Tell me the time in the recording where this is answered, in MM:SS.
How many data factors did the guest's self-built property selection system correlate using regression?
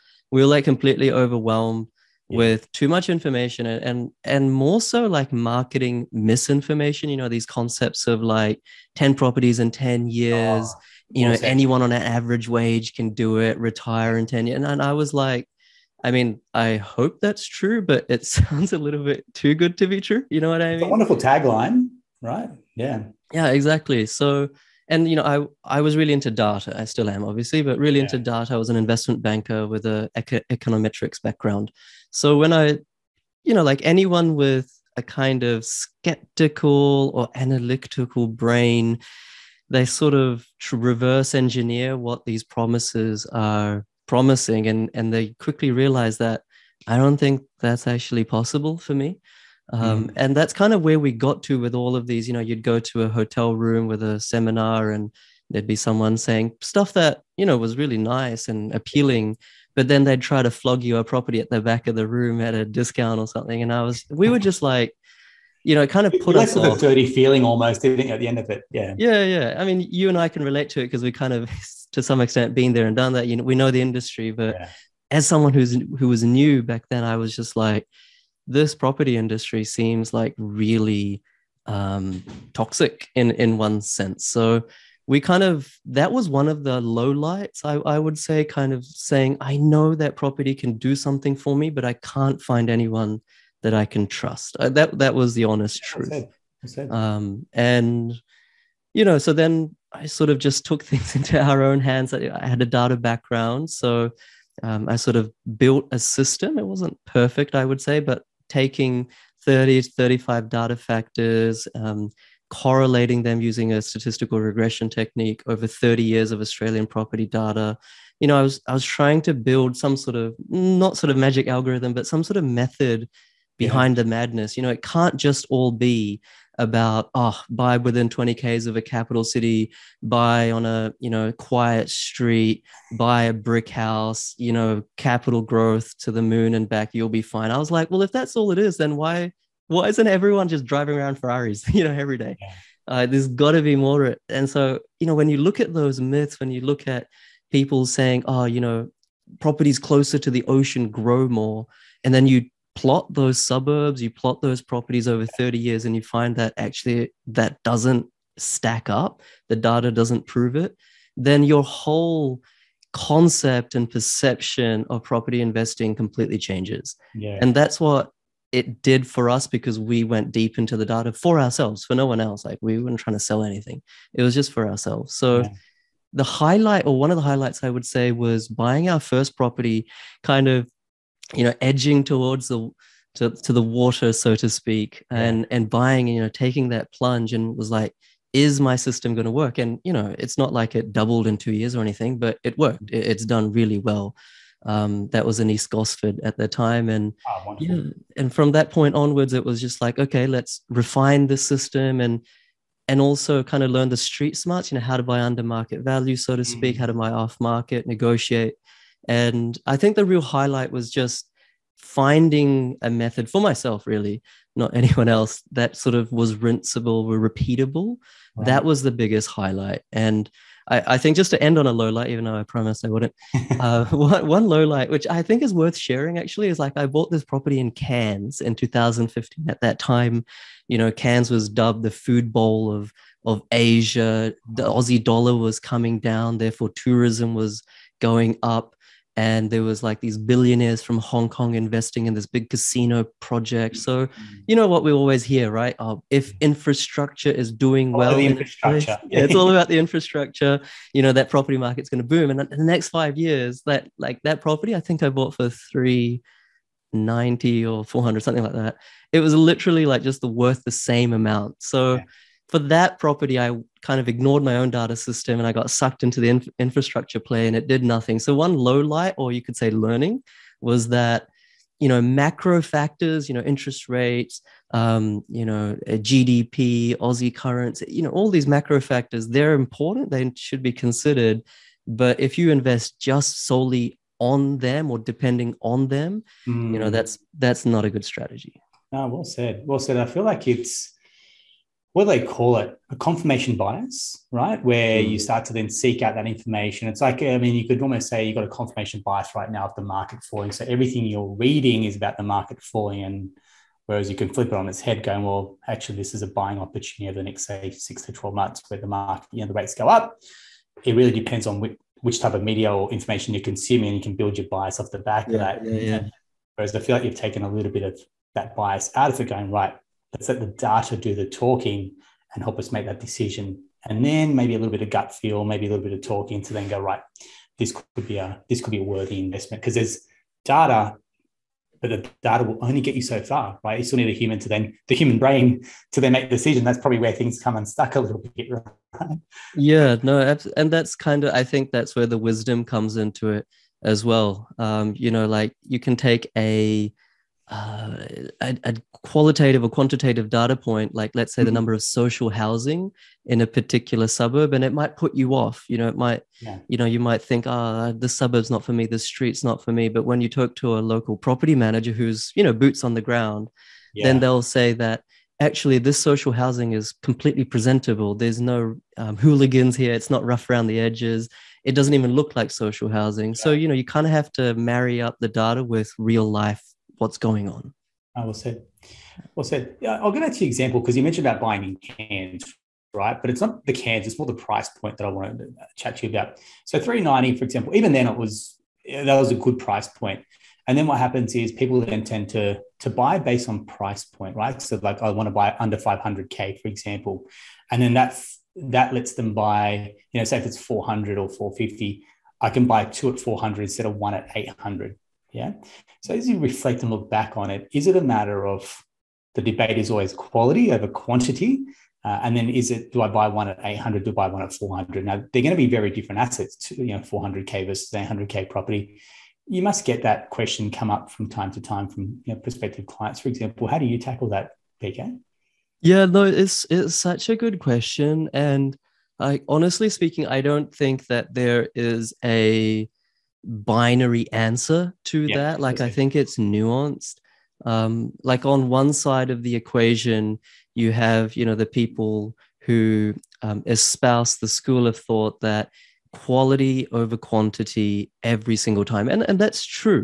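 01:49.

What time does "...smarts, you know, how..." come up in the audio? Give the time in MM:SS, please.
03:24.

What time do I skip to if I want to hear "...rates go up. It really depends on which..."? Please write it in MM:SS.
05:09.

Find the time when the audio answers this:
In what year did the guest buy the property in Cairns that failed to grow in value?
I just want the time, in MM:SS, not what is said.
03:48.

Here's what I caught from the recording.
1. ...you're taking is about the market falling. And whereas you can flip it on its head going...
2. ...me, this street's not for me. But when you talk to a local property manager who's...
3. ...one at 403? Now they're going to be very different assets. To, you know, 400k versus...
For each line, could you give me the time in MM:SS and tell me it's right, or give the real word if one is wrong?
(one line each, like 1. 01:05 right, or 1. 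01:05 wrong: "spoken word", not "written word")
1. 05:01 wrong: "reading", not "taking"
2. 05:58 right
3. 06:54 wrong: "400", not "403".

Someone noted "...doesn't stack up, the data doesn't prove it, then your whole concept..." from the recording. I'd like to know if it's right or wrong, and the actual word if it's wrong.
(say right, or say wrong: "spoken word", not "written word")
right.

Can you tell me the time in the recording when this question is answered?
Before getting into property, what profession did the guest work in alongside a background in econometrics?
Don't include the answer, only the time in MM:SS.
00:28.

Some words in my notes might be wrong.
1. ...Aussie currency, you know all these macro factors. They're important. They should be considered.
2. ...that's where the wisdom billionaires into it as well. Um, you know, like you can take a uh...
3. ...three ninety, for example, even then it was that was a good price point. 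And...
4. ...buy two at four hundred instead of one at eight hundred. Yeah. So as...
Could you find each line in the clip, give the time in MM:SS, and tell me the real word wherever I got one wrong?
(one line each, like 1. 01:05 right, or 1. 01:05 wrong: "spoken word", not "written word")
1. 04:36 right
2. 05:41 wrong: "comes", not "billionaires"
3. 06:26 right
4. 06:42 right.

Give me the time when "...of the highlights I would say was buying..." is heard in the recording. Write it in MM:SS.
02:57.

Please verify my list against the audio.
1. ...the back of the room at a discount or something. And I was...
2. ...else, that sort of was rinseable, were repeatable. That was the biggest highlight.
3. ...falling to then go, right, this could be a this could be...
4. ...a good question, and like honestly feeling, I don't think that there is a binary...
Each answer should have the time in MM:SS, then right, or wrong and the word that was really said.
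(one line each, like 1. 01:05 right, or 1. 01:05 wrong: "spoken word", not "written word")
1. 01:01 right
2. 03:35 right
3. 05:26 wrong: "talking", not "falling"
4. 07:07 wrong: "speaking", not "feeling".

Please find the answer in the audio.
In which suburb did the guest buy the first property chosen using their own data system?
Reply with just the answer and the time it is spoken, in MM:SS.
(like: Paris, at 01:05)
East Gosford, at 03:15.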